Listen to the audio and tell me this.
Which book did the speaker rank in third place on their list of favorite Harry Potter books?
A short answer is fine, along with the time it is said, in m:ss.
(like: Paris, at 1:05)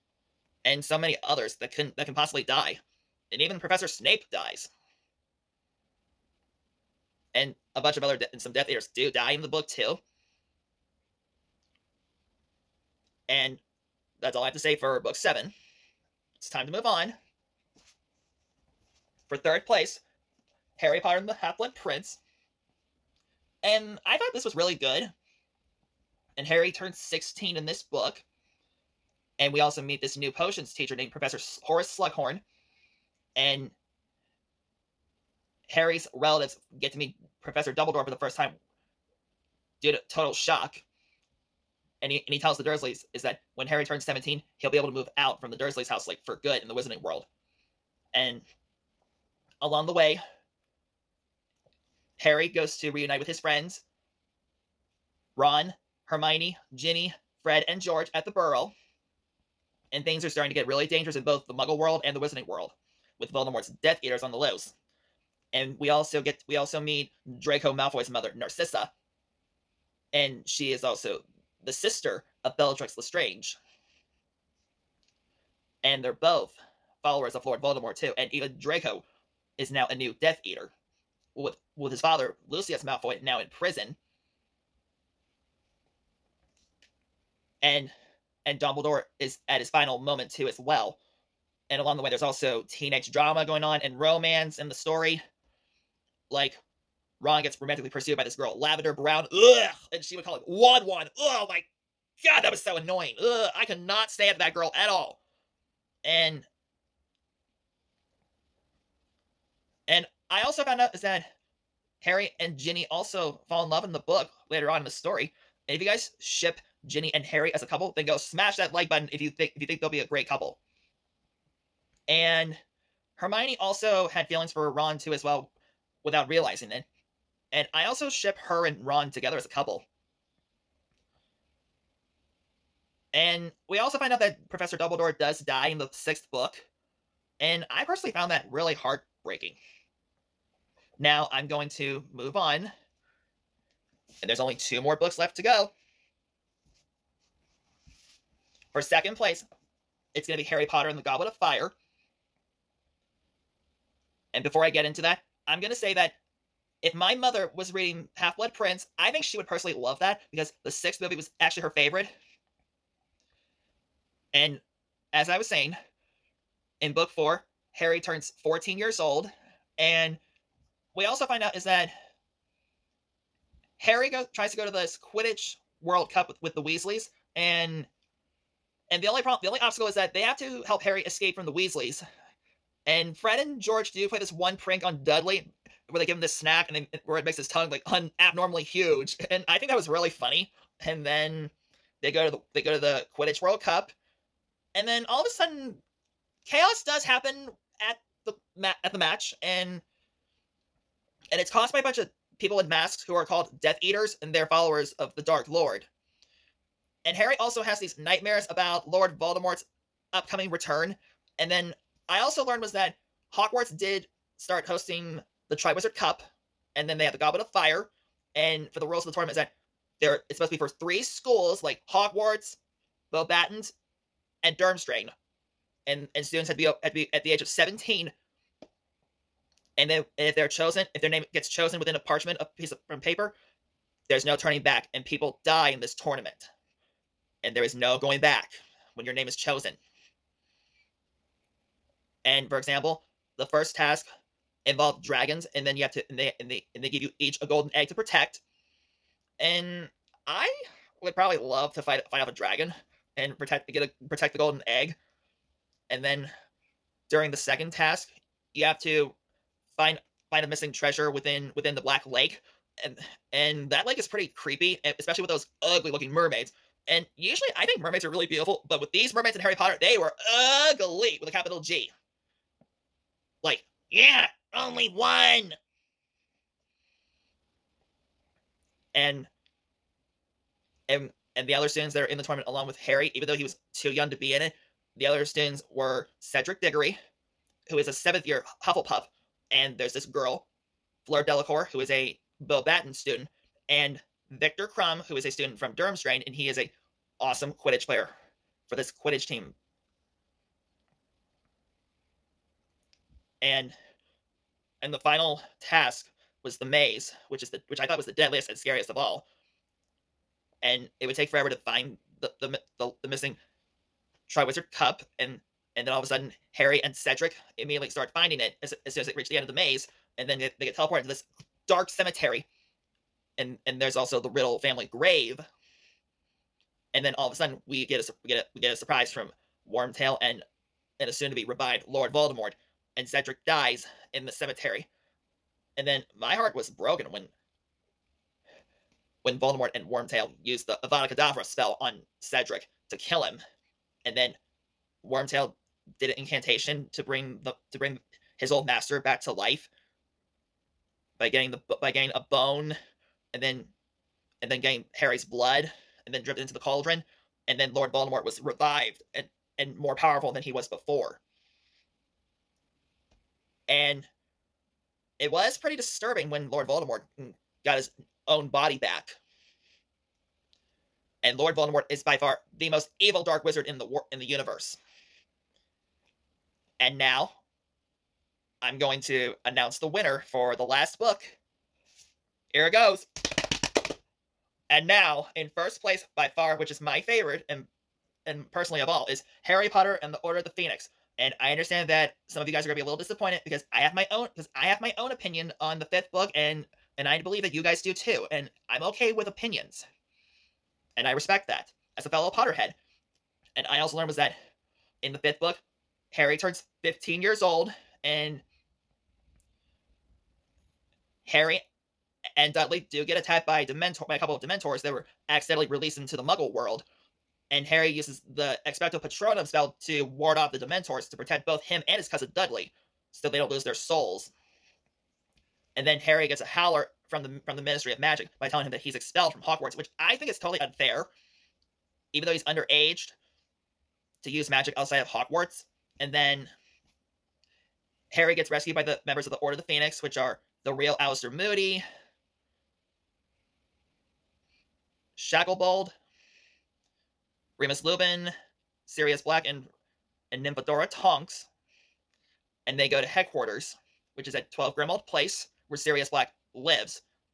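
Harry Potter and the Half Blood Prince, at 0:20.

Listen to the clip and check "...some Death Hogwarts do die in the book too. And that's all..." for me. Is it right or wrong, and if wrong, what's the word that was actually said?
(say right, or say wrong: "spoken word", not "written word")
wrong: "Eaters", not "Hogwarts".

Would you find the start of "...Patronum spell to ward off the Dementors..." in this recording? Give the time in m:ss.
6:59.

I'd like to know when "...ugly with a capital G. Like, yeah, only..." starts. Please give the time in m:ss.
4:30.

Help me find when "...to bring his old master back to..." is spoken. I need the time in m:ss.
5:47.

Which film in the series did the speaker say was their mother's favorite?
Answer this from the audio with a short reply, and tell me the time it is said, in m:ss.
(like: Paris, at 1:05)
the sixth movie, at 2:40.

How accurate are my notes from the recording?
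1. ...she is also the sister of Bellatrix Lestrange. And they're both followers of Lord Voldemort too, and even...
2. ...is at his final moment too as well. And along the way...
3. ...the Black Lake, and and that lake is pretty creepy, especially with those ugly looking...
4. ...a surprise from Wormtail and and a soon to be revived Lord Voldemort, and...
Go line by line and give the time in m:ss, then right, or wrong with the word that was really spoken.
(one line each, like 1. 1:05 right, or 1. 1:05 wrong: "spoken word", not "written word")
1. 1:10 right
2. 1:29 right
3. 4:21 right
4. 5:28 right.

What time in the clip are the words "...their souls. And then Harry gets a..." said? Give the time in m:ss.
7:03.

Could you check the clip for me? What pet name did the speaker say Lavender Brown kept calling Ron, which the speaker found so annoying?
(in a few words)
Wan Wan.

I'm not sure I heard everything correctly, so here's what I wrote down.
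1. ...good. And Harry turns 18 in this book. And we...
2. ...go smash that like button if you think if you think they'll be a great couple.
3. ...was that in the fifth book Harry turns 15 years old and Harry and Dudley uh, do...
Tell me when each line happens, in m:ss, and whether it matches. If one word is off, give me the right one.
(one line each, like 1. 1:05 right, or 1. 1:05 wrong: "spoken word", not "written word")
1. 0:24 wrong: "16", not "18"
2. 1:58 right
3. 6:44 right.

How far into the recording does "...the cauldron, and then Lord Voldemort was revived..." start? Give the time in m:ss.
5:56.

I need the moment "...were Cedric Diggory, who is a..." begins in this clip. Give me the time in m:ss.
4:45.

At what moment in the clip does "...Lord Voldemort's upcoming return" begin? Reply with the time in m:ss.
3:28.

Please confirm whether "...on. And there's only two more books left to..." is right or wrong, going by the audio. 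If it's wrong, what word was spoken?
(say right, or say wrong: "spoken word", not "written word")
right.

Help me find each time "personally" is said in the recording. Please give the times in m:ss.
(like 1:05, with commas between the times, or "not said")
2:17, 2:39, 6:28.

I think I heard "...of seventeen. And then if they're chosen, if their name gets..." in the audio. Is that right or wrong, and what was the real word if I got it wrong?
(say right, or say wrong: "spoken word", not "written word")
right.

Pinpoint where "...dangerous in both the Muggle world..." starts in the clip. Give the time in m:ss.
1:00.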